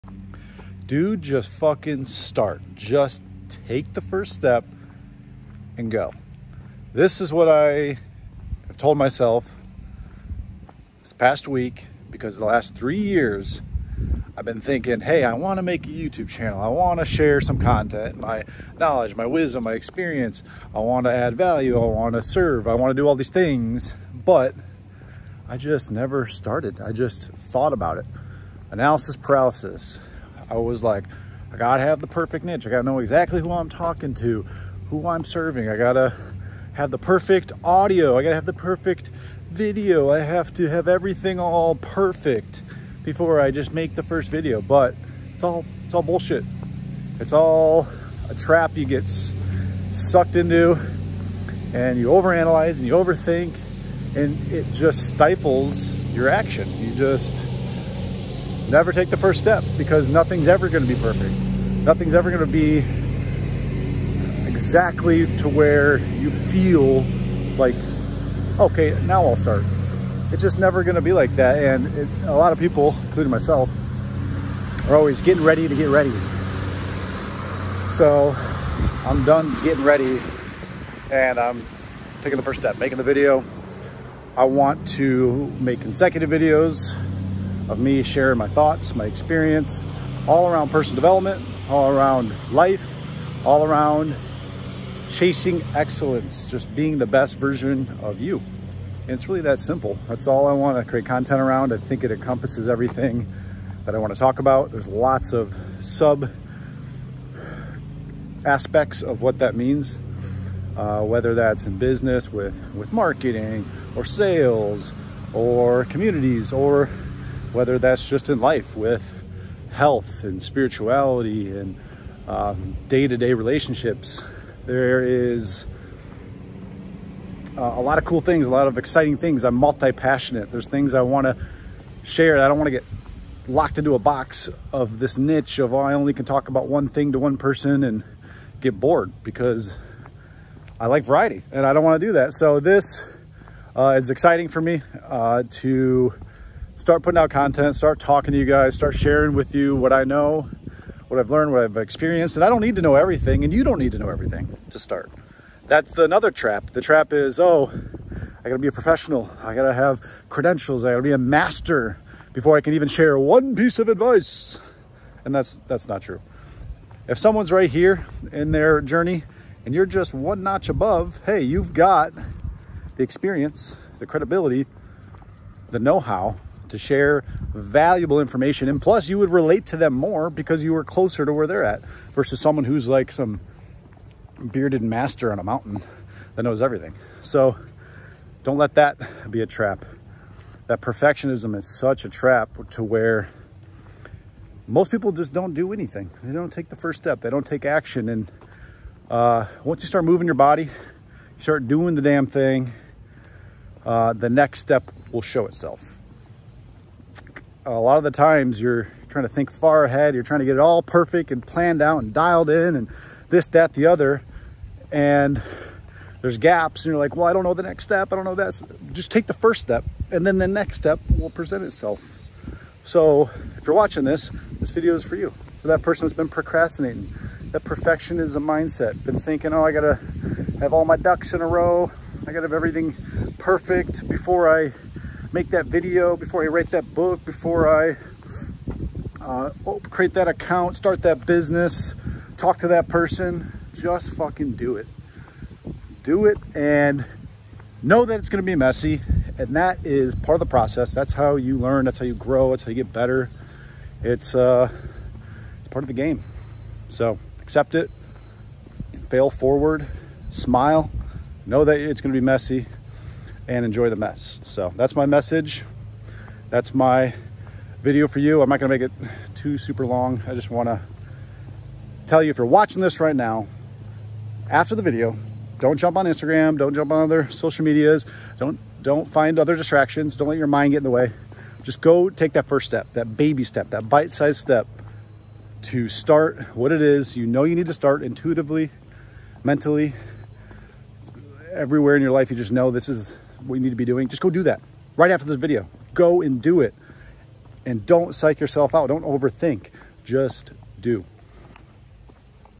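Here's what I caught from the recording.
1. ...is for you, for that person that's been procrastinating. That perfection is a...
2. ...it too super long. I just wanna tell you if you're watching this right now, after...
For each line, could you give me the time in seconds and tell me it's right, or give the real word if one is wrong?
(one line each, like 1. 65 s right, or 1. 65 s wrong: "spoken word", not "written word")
1. 224 s right
2. 268 s right.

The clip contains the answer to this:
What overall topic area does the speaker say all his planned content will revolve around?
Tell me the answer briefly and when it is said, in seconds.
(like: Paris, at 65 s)
Personal development, at 90 s.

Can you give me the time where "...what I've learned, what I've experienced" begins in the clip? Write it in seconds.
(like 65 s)
151 s.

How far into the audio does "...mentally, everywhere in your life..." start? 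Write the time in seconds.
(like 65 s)
289 s.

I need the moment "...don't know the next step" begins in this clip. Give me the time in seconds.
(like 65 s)
217 s.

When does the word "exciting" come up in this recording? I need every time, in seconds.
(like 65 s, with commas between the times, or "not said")
128 s, 144 s.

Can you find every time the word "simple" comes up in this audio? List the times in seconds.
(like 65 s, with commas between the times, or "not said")
99 s.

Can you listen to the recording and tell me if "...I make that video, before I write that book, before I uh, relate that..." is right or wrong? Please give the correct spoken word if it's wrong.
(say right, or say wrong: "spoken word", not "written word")
wrong: "create", not "relate".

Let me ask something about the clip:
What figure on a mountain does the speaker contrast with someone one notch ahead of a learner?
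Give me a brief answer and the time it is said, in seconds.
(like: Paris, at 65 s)
Bearded master, at 184 s.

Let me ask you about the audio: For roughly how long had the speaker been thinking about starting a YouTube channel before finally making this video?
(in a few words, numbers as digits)
3 years.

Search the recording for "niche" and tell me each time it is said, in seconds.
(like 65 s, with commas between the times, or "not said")
32 s, 135 s.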